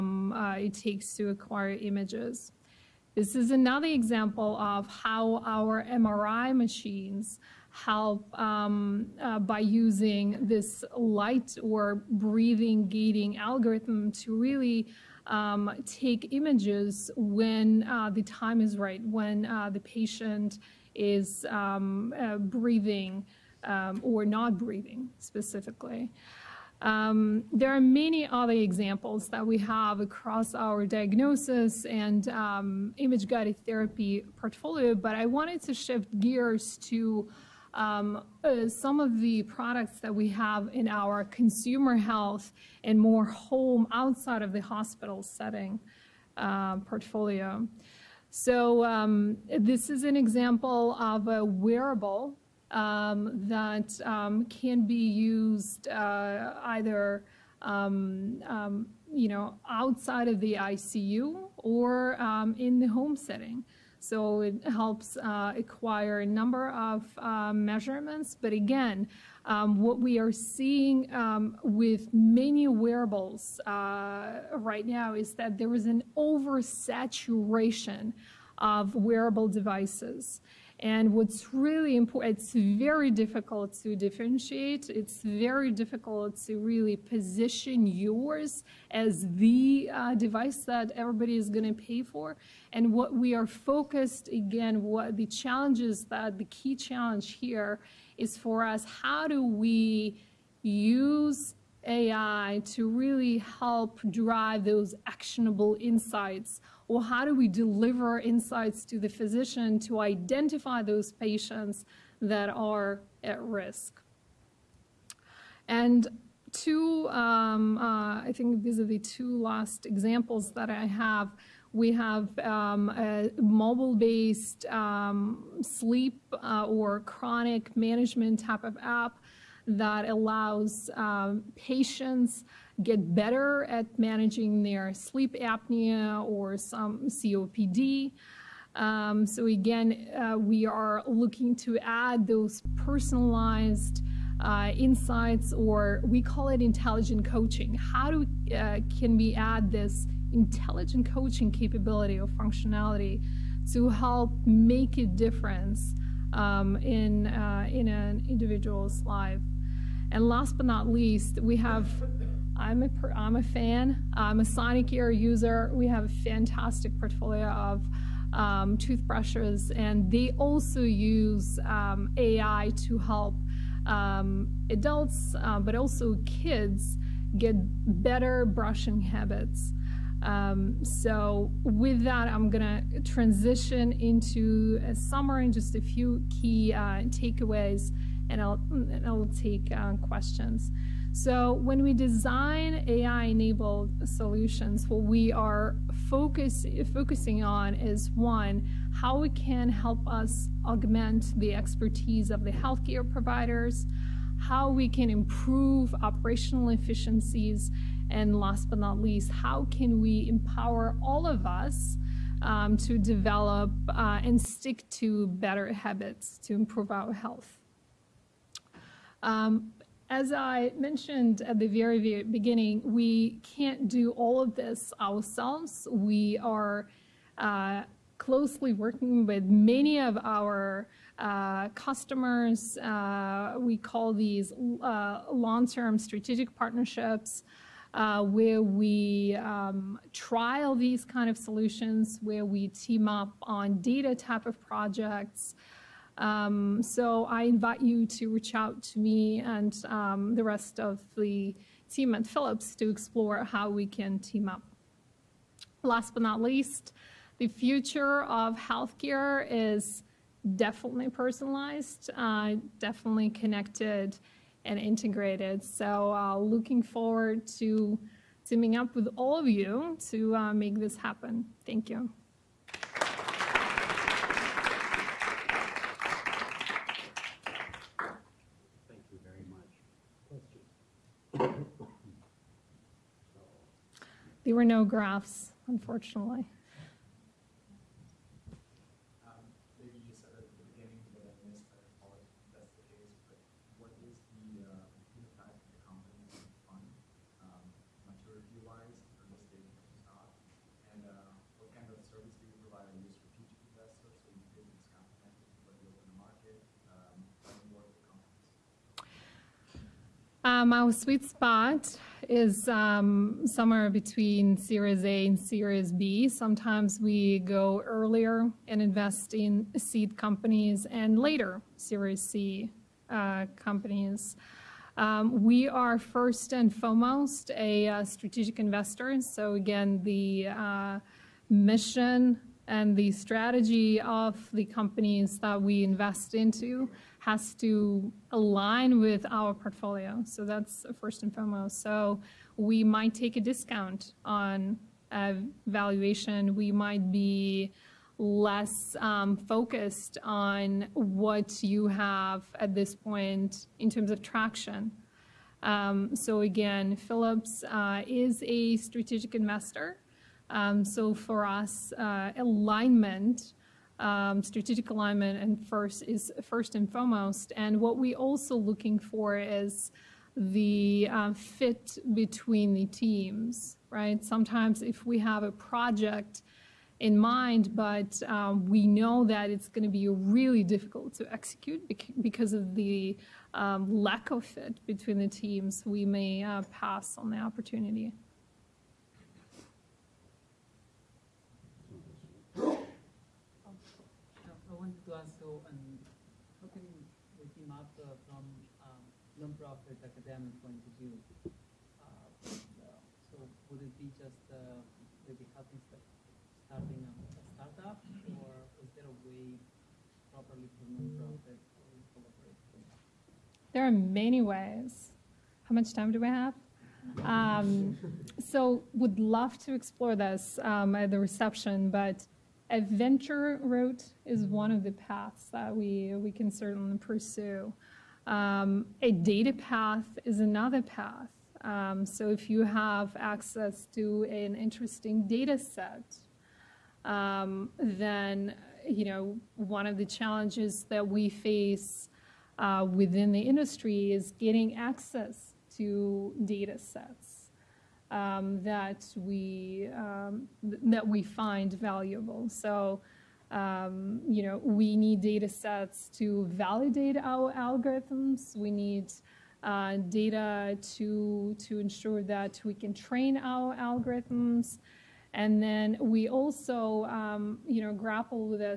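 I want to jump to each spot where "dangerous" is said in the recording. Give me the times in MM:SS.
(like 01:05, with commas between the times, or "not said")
not said.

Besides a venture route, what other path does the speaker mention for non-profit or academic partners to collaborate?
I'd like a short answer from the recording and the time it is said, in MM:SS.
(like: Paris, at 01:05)
a data path, at 07:09.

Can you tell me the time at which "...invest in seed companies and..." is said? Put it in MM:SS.
05:18.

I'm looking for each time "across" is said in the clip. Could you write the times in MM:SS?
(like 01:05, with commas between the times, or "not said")
00:30.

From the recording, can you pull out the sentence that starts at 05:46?
We might be less um, focused on what you have at this point in terms of traction.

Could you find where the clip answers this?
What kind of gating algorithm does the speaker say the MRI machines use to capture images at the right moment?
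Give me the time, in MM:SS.
00:12.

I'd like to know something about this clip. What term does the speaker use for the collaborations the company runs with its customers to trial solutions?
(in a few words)
long-term strategic partnerships.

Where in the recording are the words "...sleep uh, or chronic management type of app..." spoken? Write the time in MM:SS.
02:05.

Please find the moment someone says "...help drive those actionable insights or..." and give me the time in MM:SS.
01:43.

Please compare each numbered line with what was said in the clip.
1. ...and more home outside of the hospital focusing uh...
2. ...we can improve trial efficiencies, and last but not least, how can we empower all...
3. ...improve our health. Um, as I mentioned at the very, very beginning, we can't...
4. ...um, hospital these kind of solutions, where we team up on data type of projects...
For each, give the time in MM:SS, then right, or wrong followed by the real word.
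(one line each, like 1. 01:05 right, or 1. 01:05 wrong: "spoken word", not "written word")
1. 00:42 wrong: "setting", not "focusing"
2. 03:24 wrong: "operational", not "trial"
3. 03:36 right
4. 03:59 wrong: "trial", not "hospital".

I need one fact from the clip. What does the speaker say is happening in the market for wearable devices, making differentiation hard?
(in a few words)
oversaturation.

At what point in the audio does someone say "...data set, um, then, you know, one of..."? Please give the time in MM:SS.
07:15.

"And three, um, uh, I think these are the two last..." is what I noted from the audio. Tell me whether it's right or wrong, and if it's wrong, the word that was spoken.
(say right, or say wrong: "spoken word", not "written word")
wrong: "two", not "three".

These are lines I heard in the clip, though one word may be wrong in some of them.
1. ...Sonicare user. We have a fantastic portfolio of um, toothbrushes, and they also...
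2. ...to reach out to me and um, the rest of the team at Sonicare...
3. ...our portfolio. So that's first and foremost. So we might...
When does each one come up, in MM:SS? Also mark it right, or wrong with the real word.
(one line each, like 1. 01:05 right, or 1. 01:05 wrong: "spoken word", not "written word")
1. 02:44 right
2. 04:08 wrong: "Philips", not "Sonicare"
3. 05:39 right.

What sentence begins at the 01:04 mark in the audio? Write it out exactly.
So it helps uh, acquire a number of uh, measurements.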